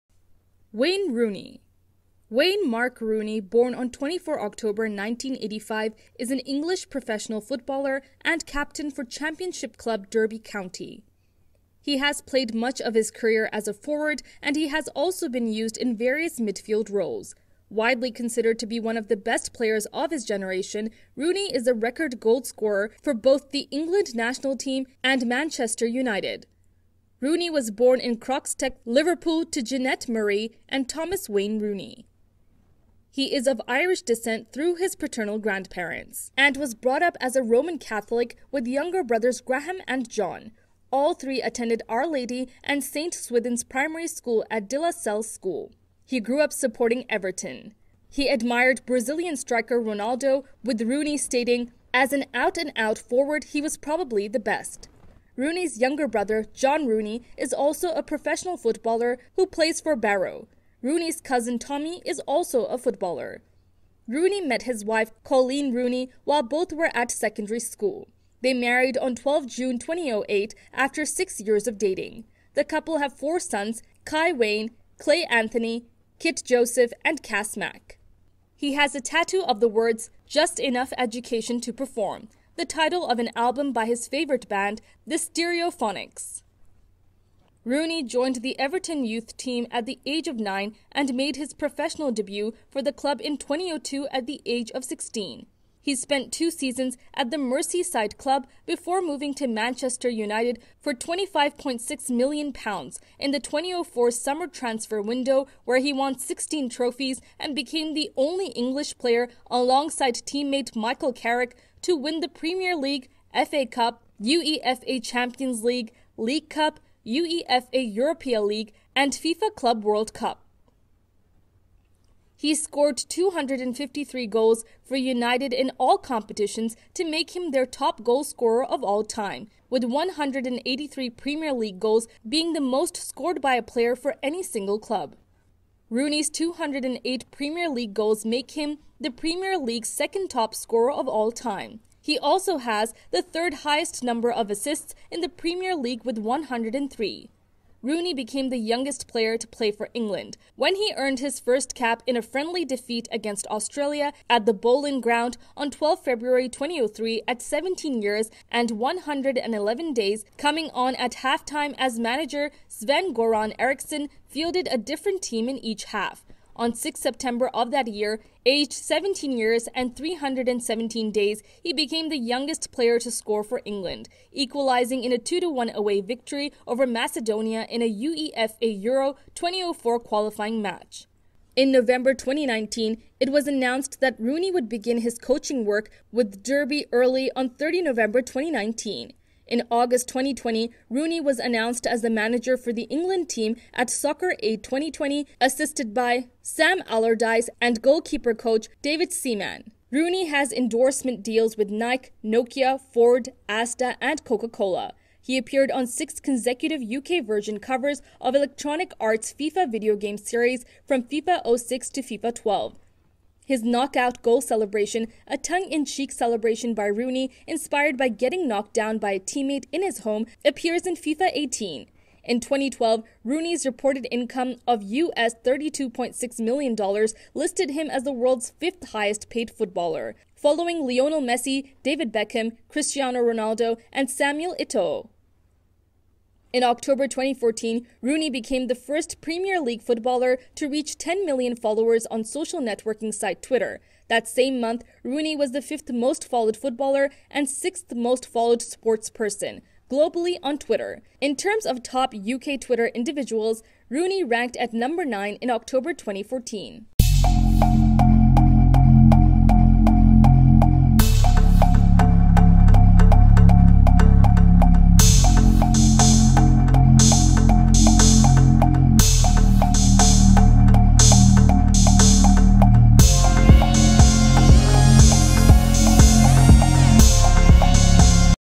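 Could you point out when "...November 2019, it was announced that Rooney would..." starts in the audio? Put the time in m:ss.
3:01.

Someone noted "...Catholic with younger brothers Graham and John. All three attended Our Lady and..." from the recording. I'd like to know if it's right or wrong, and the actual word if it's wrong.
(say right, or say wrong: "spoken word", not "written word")
right.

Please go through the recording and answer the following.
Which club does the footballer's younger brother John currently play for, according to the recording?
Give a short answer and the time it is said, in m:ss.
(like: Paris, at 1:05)
Barrow, at 0:59.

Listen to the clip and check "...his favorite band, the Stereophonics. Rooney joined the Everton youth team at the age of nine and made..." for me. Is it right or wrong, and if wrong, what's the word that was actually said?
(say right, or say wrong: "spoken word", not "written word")
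right.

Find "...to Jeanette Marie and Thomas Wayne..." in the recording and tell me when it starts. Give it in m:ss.
0:29.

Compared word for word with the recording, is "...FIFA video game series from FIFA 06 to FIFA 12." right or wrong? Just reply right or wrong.
right.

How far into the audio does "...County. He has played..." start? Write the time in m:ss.
0:10.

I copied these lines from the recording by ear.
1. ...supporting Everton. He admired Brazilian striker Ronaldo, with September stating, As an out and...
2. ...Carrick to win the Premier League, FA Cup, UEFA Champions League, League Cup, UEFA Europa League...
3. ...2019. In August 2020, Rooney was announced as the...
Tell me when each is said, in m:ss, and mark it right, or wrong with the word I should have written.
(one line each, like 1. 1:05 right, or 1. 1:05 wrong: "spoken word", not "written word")
1. 0:46 wrong: "Rooney", not "September"
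2. 1:51 right
3. 3:08 right.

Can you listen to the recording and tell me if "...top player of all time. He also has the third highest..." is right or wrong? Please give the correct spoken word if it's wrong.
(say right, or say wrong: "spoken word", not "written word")
wrong: "scorer", not "player".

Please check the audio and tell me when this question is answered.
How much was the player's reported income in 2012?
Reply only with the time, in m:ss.
3:44.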